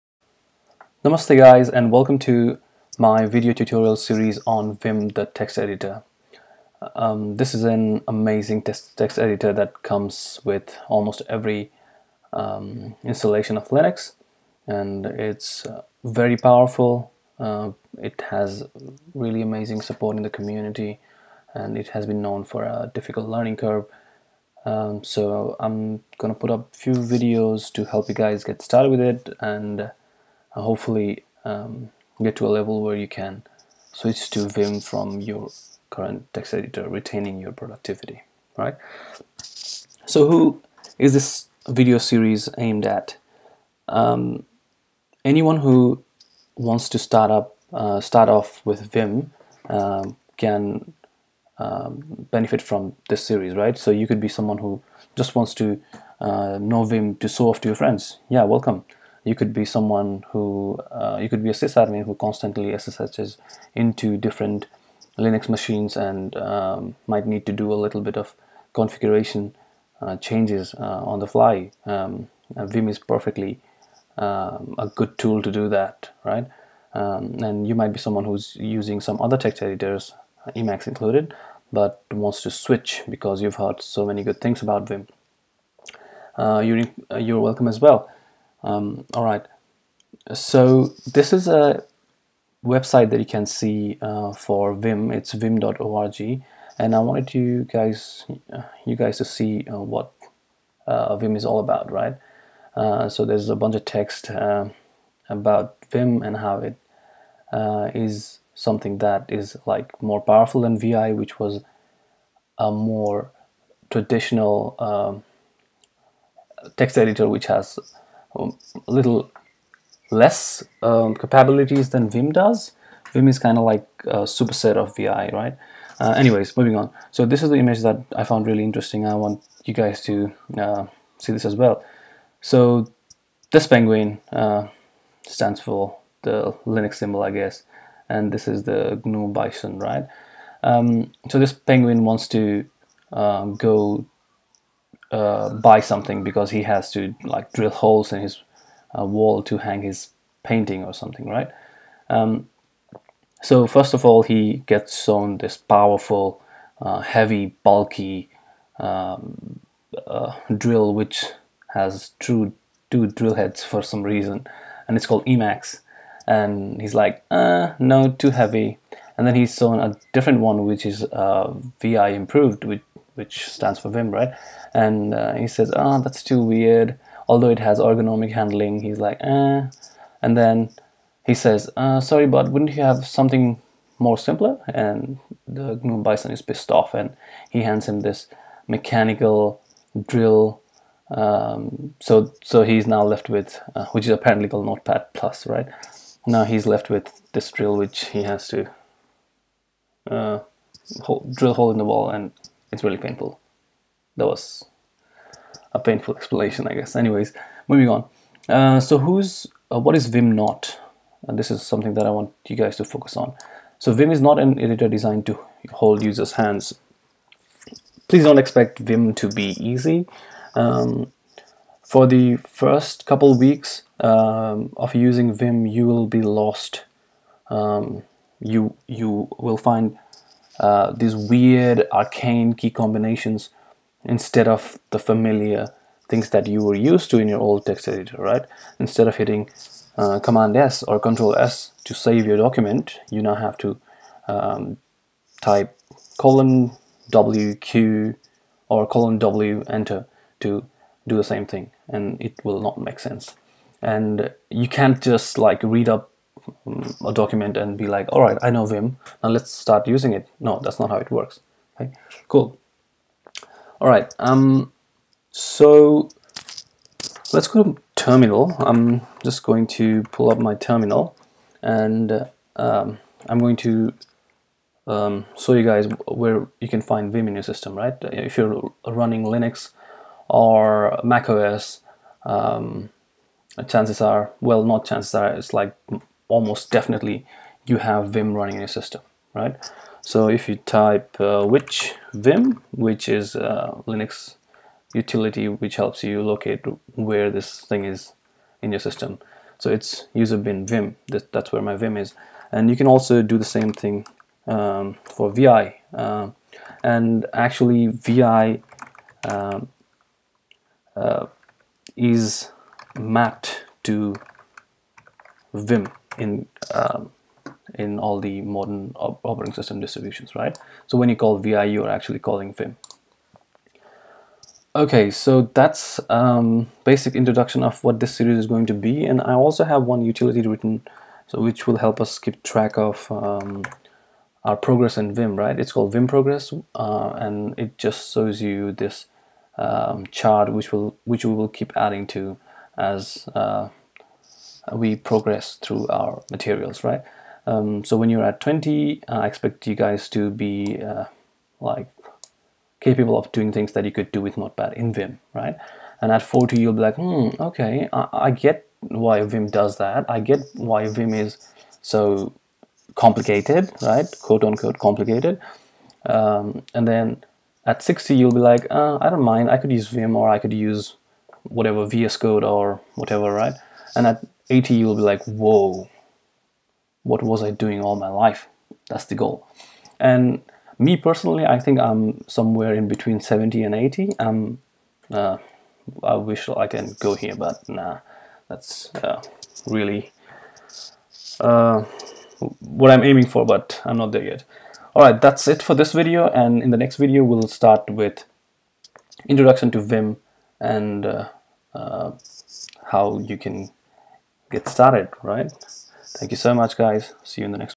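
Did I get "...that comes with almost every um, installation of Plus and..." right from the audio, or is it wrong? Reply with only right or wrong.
wrong.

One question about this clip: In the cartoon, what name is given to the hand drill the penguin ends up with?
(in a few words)
Notepad Plus.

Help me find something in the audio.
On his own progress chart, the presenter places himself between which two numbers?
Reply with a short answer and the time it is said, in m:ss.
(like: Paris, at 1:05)
70 and 80, at 6:23.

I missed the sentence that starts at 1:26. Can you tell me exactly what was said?
Uh, you're, uh, you're welcome as well.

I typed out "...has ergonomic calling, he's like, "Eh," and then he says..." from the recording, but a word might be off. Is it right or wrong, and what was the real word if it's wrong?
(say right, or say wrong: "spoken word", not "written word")
wrong: "handling", not "calling".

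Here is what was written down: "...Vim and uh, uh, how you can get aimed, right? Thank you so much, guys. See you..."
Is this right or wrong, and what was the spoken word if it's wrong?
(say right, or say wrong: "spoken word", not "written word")
wrong: "started", not "aimed".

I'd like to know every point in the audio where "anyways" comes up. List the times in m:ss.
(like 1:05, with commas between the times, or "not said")
2:06, 3:26.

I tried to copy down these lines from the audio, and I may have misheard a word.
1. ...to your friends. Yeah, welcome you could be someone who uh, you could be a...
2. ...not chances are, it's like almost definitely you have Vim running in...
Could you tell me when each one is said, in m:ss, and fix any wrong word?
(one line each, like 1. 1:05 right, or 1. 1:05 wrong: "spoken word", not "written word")
1. 0:57 right
2. 4:44 right.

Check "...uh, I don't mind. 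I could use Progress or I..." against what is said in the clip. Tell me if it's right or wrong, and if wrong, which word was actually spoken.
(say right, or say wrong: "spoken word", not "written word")
wrong: "Vim", not "Progress".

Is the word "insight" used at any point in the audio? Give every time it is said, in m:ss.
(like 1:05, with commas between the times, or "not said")
not said.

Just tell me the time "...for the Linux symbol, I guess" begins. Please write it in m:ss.
2:15.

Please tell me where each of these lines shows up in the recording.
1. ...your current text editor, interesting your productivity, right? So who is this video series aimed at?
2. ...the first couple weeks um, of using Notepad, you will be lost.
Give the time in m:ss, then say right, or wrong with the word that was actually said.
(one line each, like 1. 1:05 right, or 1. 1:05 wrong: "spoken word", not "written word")
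1. 0:35 wrong: "retaining", not "interesting"
2. 3:42 wrong: "Vim", not "Notepad".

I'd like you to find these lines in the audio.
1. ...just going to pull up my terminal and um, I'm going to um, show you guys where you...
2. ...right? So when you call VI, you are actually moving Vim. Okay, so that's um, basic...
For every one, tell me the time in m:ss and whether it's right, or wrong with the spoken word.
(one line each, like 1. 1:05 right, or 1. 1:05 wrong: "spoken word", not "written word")
1. 4:29 right
2. 5:20 wrong: "calling", not "moving".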